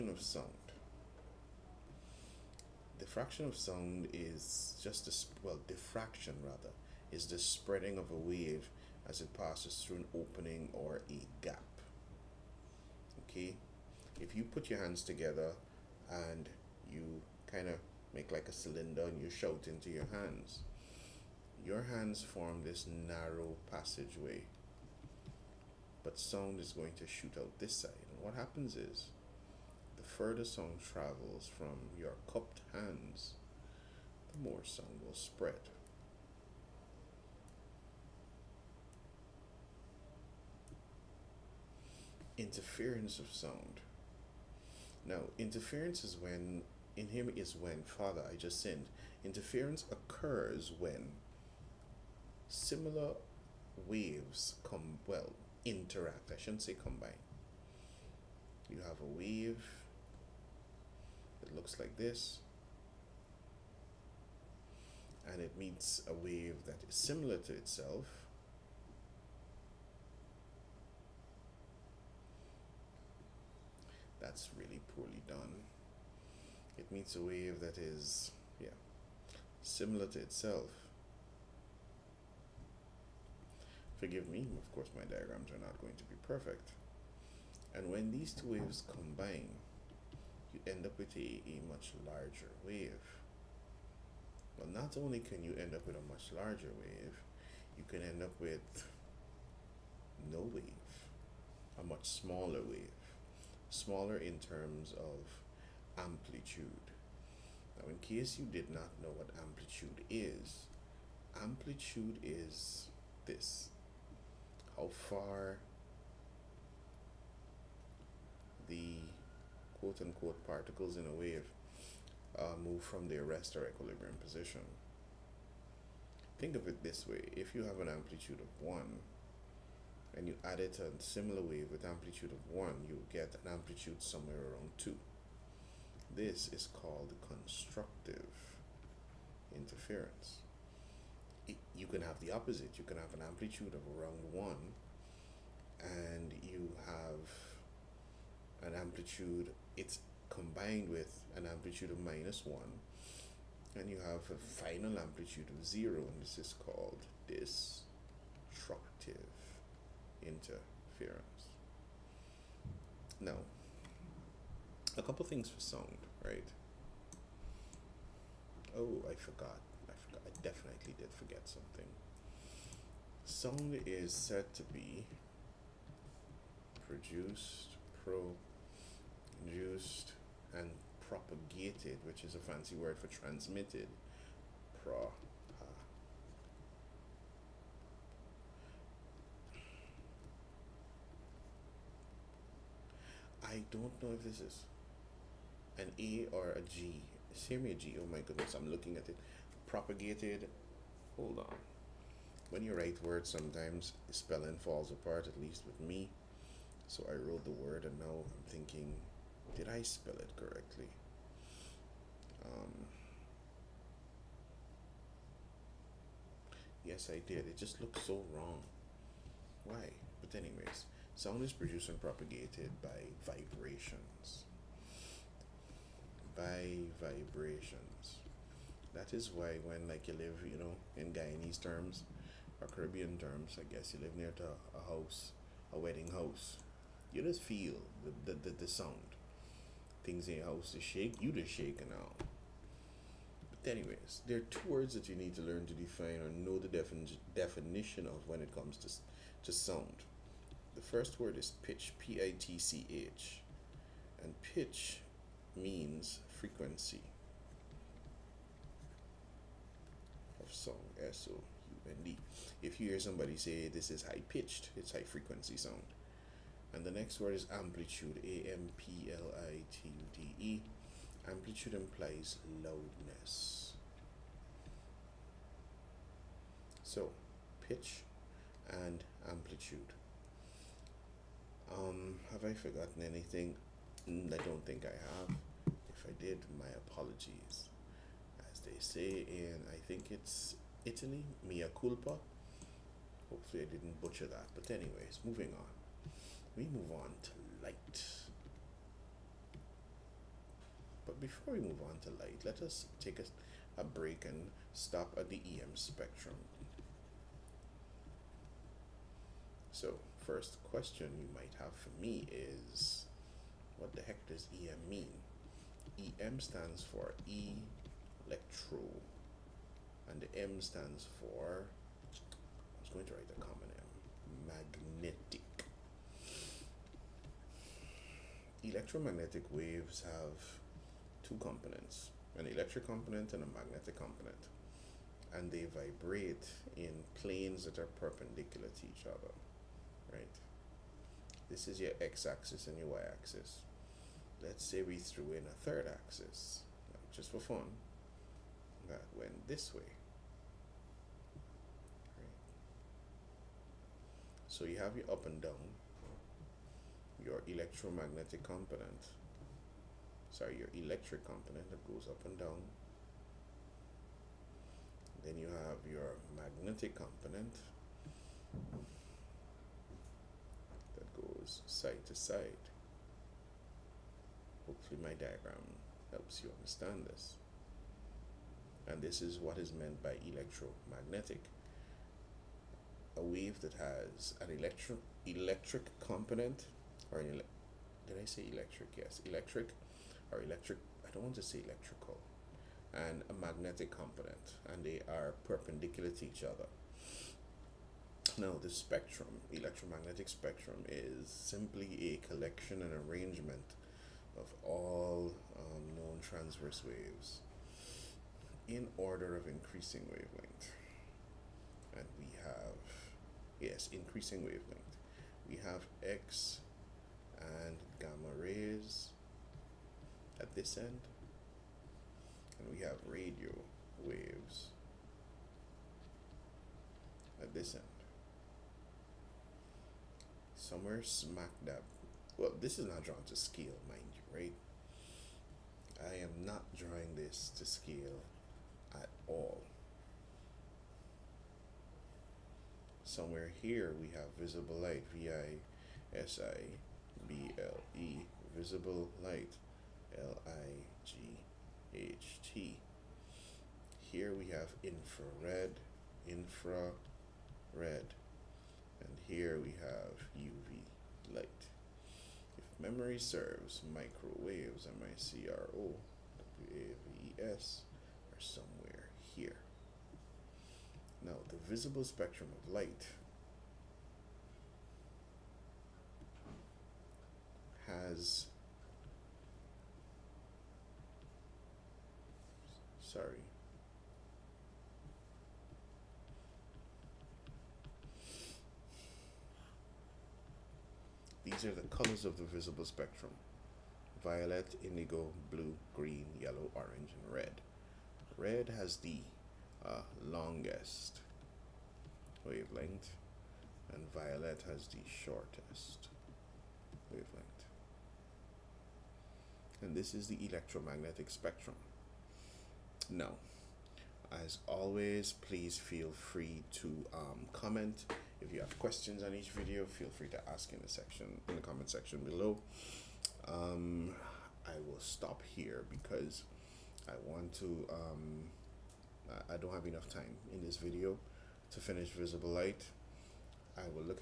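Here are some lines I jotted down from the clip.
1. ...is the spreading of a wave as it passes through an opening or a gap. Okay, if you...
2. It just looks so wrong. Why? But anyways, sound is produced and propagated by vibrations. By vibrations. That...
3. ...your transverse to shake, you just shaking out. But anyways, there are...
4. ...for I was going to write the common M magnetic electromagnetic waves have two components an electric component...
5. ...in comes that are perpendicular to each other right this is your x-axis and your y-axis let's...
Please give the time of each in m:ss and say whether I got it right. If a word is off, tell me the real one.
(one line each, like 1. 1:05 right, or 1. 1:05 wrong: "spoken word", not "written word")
1. 0:07 right
2. 3:37 right
3. 4:00 wrong: "house", not "transverse"
4. 5:21 right
5. 5:36 wrong: "planes", not "comes".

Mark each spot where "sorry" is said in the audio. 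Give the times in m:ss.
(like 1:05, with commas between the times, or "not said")
6:00, 8:03.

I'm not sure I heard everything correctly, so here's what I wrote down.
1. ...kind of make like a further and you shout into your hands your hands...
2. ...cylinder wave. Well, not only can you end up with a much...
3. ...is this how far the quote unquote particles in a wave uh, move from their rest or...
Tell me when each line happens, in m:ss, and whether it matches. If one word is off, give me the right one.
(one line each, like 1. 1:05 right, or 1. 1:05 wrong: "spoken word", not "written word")
1. 0:17 wrong: "cylinder", not "further"
2. 1:32 wrong: "larger", not "cylinder"
3. 1:52 right.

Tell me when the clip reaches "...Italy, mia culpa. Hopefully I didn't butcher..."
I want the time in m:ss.
4:50.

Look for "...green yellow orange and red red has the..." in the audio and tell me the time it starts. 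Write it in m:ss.
8:15.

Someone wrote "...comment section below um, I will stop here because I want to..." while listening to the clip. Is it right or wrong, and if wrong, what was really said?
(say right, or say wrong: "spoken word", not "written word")
right.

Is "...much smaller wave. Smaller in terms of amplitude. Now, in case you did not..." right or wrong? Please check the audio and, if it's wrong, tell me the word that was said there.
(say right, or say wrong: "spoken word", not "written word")
right.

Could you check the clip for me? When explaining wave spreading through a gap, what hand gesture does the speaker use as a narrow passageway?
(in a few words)
Cupped hands.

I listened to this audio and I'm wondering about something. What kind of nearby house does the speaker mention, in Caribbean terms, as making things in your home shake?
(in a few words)
A wedding house.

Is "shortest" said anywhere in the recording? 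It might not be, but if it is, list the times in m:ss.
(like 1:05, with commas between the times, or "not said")
8:25.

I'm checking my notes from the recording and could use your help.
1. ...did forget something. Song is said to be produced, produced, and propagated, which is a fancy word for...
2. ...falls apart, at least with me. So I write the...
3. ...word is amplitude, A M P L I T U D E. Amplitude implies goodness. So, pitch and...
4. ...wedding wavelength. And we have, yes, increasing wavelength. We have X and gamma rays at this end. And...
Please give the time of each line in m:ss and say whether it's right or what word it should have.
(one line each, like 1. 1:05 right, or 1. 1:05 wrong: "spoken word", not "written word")
1. 2:50 right
2. 3:24 wrong: "wrote", not "write"
3. 4:27 wrong: "loudness", not "goodness"
4. 6:49 wrong: "increasing", not "wedding".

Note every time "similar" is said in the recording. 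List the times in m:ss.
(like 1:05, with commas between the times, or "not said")
0:52, 1:06, 1:19, 2:11.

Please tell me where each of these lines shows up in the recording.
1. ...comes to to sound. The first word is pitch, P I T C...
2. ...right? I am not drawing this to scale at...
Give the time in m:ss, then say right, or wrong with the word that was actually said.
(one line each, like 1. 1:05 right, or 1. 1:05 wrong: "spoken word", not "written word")
1. 4:08 right
2. 7:14 right.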